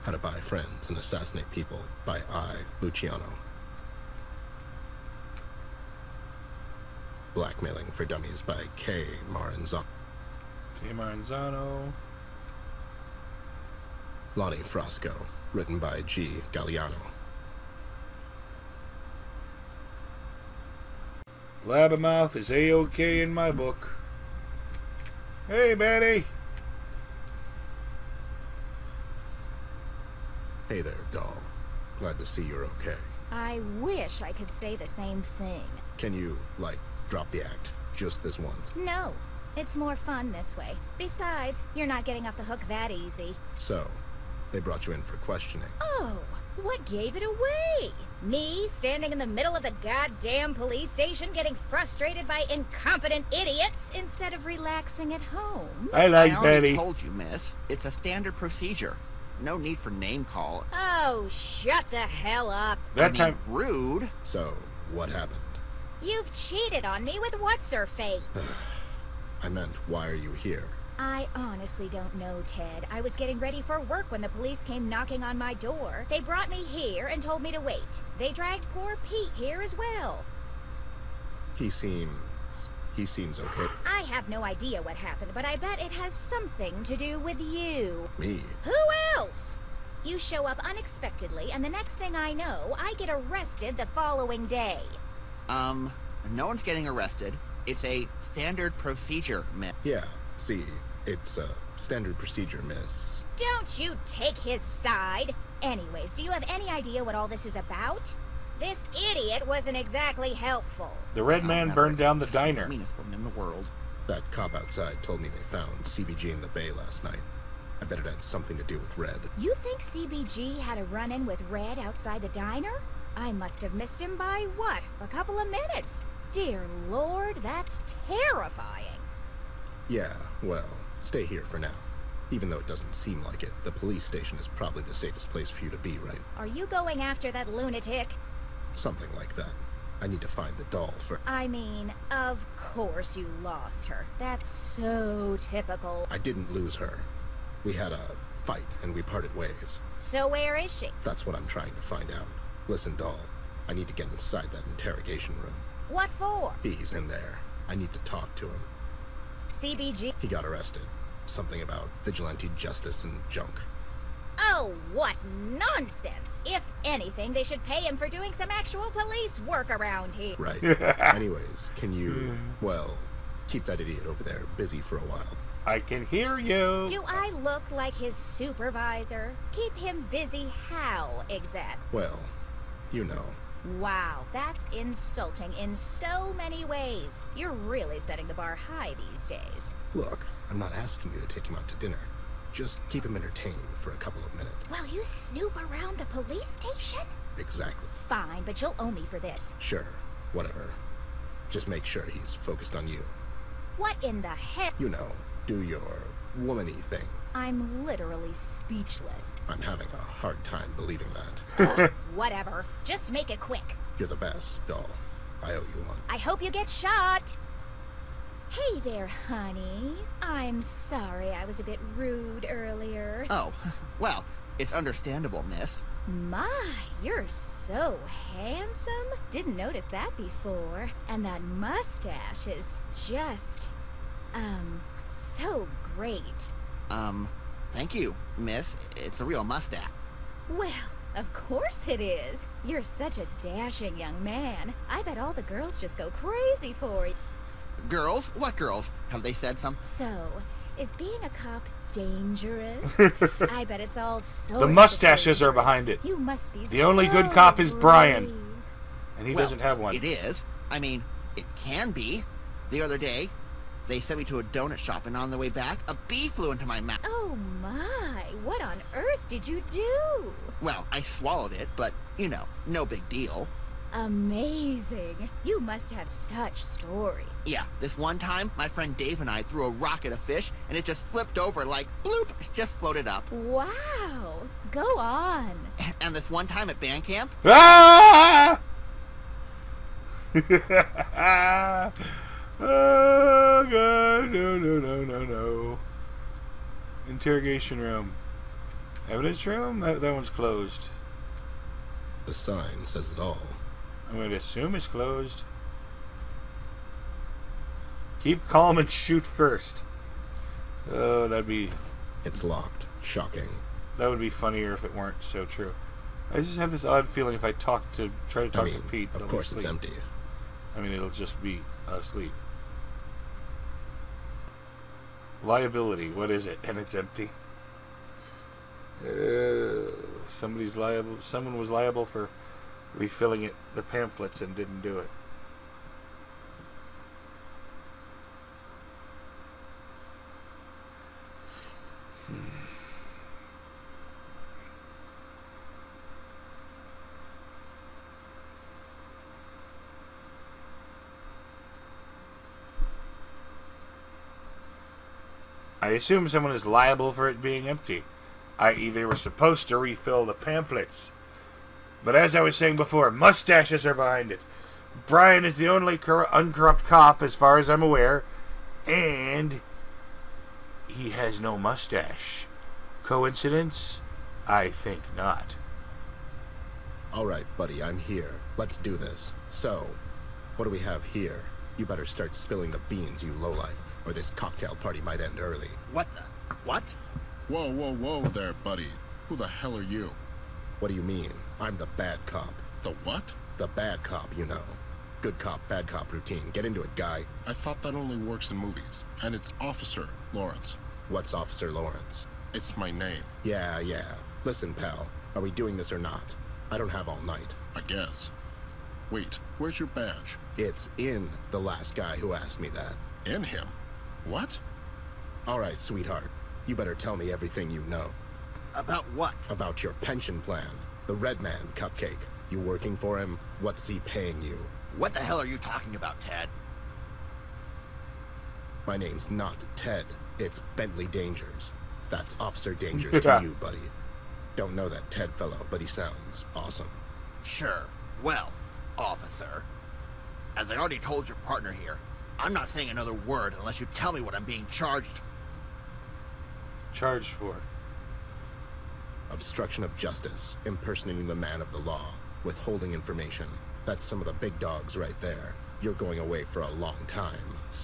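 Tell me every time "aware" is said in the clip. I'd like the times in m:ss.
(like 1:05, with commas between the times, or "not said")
6:07.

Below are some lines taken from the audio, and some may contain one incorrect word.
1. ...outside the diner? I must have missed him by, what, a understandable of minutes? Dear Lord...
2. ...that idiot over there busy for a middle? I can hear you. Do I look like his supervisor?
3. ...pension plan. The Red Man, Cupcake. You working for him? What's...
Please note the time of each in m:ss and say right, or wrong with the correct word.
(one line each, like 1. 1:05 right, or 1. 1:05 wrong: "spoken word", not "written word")
1. 2:01 wrong: "couple", not "understandable"
2. 2:53 wrong: "while", not "middle"
3. 6:59 right.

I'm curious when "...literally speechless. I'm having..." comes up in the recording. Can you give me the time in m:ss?
3:27.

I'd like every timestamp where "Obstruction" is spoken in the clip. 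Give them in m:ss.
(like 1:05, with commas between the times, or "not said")
7:29.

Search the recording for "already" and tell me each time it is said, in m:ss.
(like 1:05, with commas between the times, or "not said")
0:56, 7:20.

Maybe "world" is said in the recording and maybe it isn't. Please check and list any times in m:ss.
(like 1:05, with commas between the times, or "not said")
1:53.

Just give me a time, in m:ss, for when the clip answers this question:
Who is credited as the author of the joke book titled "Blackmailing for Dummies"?
0:07.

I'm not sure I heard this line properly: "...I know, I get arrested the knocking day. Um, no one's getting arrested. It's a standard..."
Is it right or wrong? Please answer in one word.
wrong.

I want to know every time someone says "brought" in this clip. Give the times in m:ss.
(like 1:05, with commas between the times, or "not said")
0:44, 1:16.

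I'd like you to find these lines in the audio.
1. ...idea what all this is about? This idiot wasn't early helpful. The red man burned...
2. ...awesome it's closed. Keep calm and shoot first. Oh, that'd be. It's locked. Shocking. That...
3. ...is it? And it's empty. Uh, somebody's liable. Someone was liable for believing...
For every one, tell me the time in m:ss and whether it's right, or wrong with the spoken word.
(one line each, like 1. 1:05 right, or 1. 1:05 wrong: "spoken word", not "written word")
1. 1:46 wrong: "exactly", not "early"
2. 5:04 wrong: "assume", not "awesome"
3. 5:26 wrong: "refilling", not "believing".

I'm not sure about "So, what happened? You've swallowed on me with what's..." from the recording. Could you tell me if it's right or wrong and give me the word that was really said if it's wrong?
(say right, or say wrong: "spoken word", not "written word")
wrong: "cheated", not "swallowed".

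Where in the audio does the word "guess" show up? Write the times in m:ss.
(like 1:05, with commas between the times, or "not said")
6:47.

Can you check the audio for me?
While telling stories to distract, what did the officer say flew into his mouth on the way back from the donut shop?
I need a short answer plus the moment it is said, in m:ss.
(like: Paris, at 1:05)
A bee, at 4:25.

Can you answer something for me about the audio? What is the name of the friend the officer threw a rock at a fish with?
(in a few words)
Dave.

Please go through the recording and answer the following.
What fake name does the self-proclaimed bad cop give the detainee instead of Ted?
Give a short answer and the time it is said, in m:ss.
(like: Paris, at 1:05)
Bentley Dangers, at 7:10.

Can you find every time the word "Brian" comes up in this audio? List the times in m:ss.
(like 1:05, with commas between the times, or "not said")
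4:17, 6:05.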